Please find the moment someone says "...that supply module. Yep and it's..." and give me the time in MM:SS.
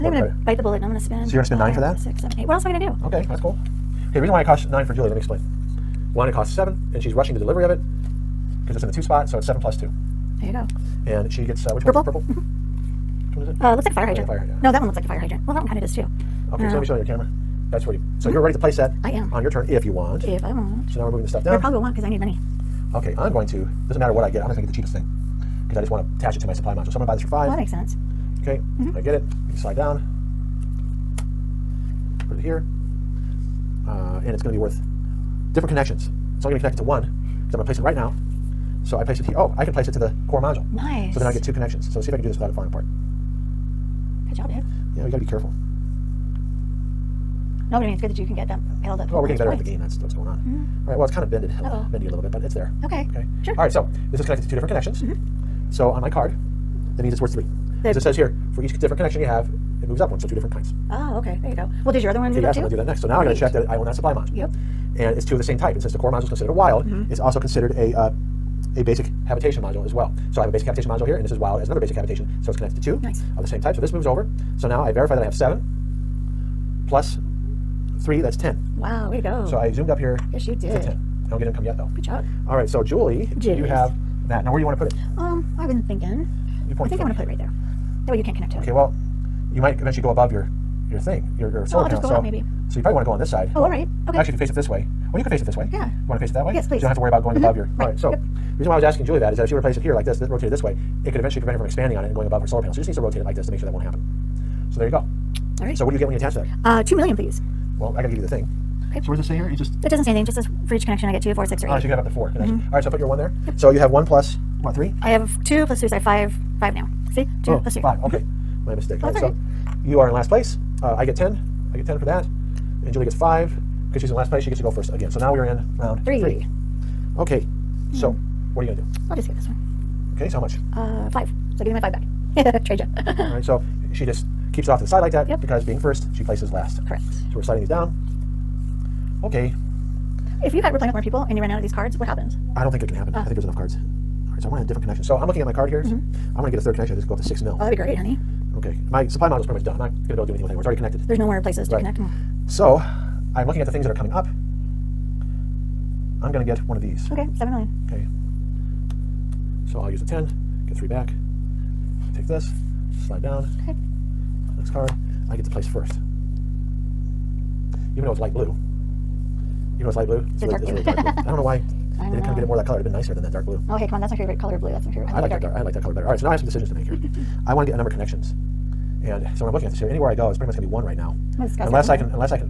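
01:03.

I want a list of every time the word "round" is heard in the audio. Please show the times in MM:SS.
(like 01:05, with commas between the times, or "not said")
02:05.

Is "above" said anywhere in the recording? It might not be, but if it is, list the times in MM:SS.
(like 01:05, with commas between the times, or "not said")
01:30, 01:37, 01:42.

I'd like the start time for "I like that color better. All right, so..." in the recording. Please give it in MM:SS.
02:55.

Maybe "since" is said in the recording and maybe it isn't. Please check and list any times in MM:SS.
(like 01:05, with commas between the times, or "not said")
01:05.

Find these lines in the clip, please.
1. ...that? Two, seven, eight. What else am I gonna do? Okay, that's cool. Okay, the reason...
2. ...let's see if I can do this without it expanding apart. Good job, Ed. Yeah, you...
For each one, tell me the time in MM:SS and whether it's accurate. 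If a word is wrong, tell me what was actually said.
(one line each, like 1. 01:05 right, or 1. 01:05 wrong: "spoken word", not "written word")
1. 00:01 wrong: "Six", not "Two"
2. 00:41 wrong: "falling", not "expanding".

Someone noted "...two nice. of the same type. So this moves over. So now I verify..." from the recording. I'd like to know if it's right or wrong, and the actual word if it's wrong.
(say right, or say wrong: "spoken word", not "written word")
right.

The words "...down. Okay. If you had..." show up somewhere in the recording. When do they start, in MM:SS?
02:17.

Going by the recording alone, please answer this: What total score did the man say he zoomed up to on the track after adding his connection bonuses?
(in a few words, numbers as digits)
10.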